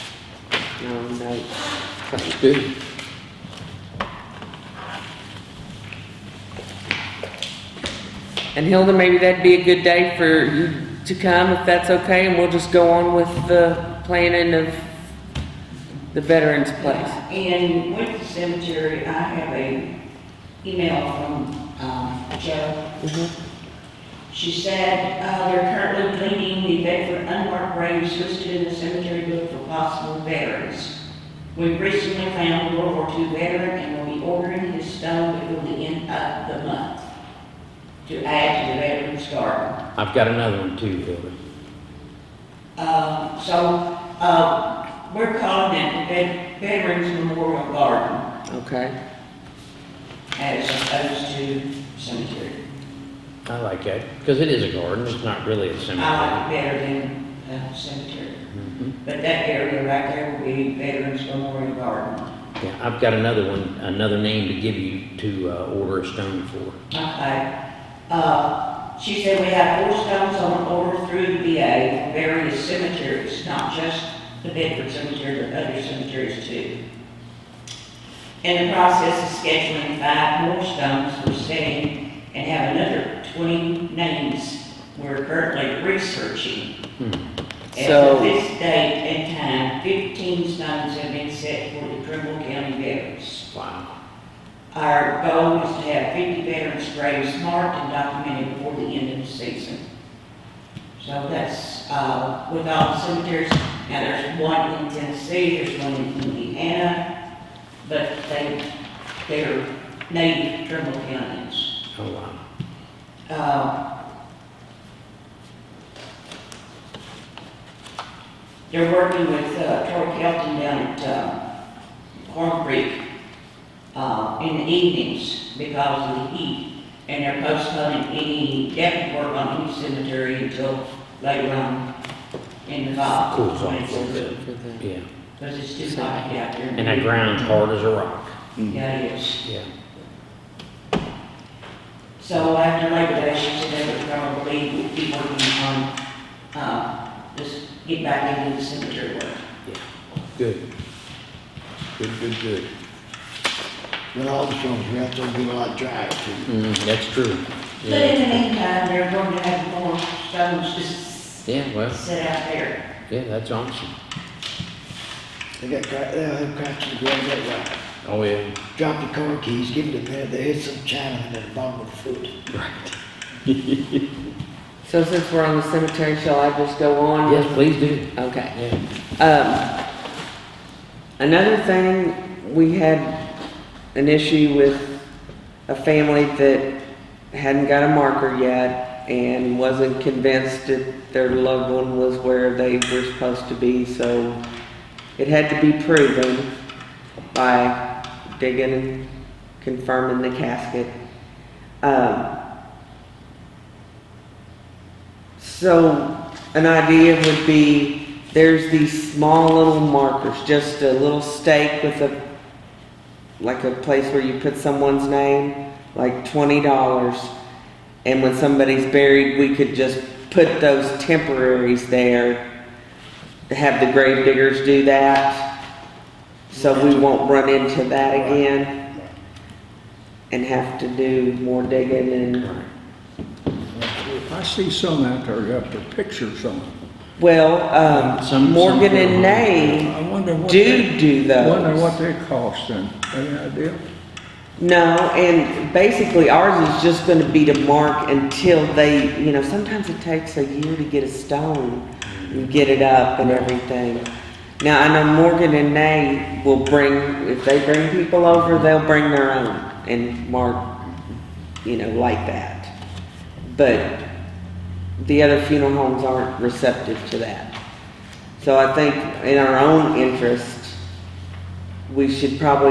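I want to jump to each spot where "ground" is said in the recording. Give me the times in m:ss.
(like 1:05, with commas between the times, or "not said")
2:17, 2:47.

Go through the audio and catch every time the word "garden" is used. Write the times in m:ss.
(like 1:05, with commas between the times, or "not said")
0:39, 0:47, 0:54, 1:01.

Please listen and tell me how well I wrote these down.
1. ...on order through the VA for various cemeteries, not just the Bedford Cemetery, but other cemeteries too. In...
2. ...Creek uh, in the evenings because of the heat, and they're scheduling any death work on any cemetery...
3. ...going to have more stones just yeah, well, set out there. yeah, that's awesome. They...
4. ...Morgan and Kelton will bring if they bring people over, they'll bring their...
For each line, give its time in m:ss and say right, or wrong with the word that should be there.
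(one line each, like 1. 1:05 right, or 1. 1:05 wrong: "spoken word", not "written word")
1. 1:10 right
2. 2:02 wrong: "postponing", not "scheduling"
3. 2:39 right
4. 4:15 wrong: "Nay", not "Kelton".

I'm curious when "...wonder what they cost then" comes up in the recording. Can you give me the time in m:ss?
4:01.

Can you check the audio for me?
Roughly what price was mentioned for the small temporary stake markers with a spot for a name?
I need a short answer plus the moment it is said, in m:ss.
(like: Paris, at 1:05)
$20, at 3:36.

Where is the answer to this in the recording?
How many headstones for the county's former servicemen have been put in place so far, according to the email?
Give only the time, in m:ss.
1:29.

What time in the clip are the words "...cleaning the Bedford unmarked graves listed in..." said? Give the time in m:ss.
0:26.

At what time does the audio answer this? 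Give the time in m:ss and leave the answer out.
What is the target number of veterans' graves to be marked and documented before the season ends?
1:36.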